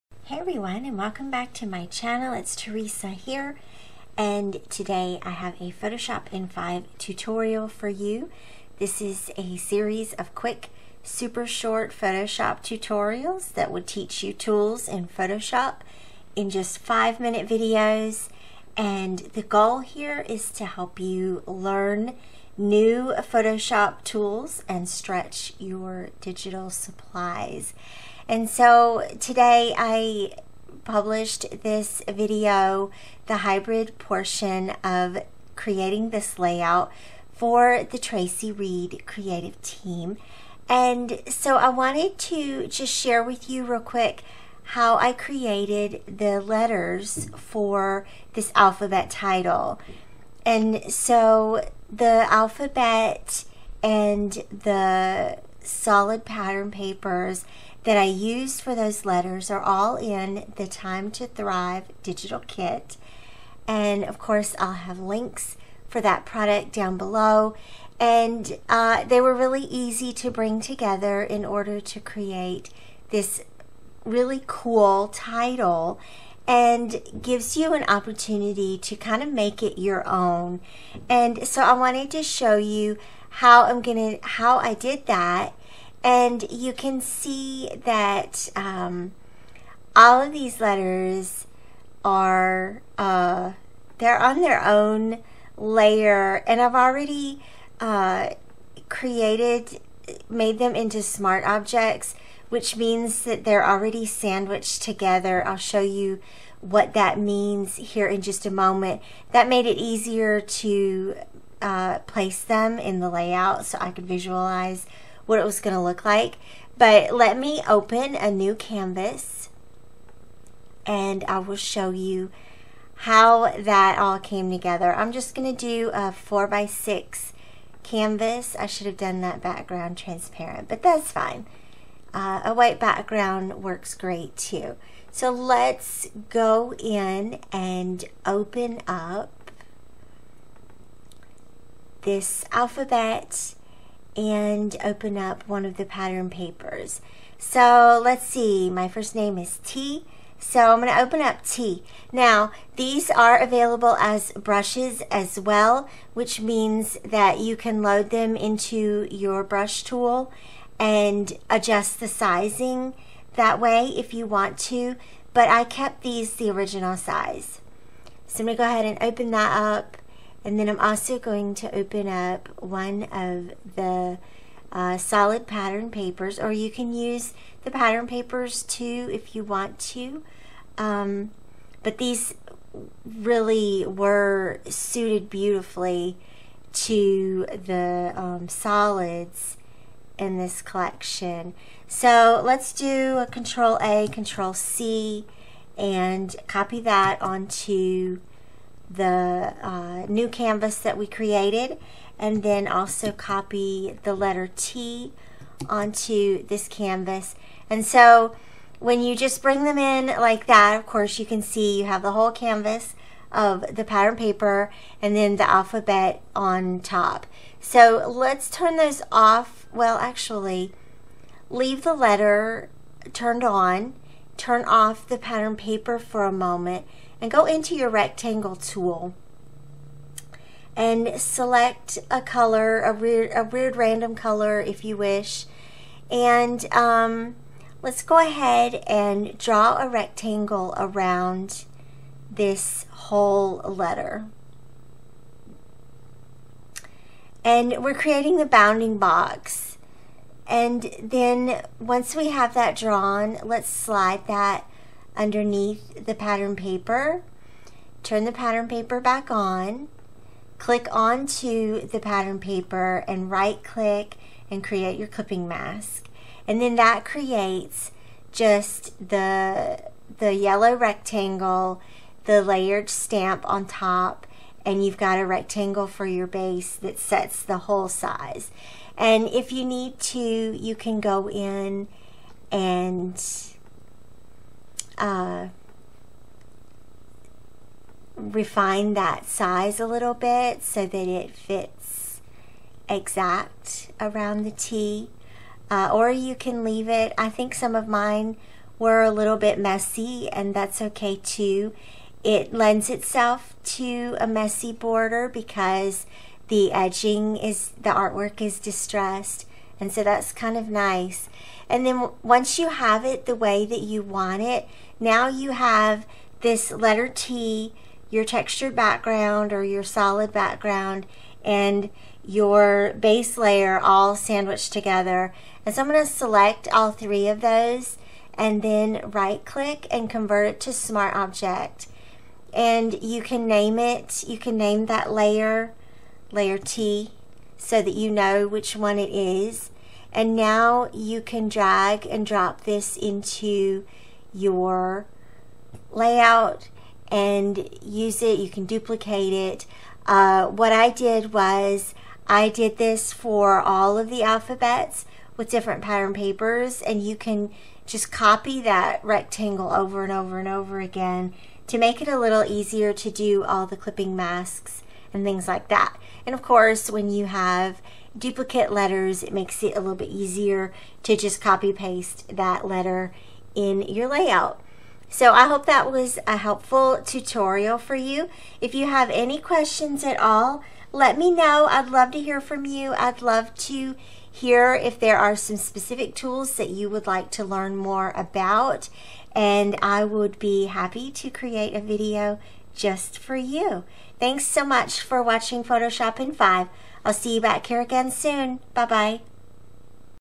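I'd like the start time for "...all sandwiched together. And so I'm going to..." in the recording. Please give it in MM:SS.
05:23.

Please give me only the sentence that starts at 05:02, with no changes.
It lends itself to a messy border because the edging is, the artwork is distressed.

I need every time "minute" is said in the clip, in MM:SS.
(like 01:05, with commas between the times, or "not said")
00:17.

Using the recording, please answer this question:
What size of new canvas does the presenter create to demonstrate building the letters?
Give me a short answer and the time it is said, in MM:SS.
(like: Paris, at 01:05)
4 by 6, at 02:06.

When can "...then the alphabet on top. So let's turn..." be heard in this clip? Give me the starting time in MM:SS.
03:35.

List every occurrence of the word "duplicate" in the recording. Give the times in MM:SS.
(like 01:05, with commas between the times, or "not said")
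05:48, 06:08.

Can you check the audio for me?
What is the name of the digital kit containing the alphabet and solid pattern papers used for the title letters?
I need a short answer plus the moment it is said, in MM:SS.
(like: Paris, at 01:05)
Time to Thrive, at 01:00.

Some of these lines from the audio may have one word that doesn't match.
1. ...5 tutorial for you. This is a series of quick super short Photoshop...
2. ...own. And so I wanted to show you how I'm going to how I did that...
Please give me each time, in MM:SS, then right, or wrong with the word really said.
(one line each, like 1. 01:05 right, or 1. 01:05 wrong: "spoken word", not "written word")
1. 00:06 right
2. 01:20 right.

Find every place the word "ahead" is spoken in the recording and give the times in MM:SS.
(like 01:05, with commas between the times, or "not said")
02:48, 03:58.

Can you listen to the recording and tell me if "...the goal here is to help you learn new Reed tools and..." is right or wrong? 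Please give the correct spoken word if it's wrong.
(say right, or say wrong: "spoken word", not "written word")
wrong: "Photoshop", not "Reed".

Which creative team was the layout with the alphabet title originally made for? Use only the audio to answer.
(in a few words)
Traci Reed.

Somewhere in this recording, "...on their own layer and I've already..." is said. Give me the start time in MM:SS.
01:34.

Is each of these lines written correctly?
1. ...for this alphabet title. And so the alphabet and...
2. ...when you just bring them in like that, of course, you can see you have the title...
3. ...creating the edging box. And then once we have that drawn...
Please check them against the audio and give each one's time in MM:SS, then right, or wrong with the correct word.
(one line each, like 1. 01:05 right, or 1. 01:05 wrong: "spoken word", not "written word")
1. 00:47 right
2. 03:28 wrong: "whole", not "title"
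3. 04:07 wrong: "bounding", not "edging".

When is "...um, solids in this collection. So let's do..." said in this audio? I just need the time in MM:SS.
03:08.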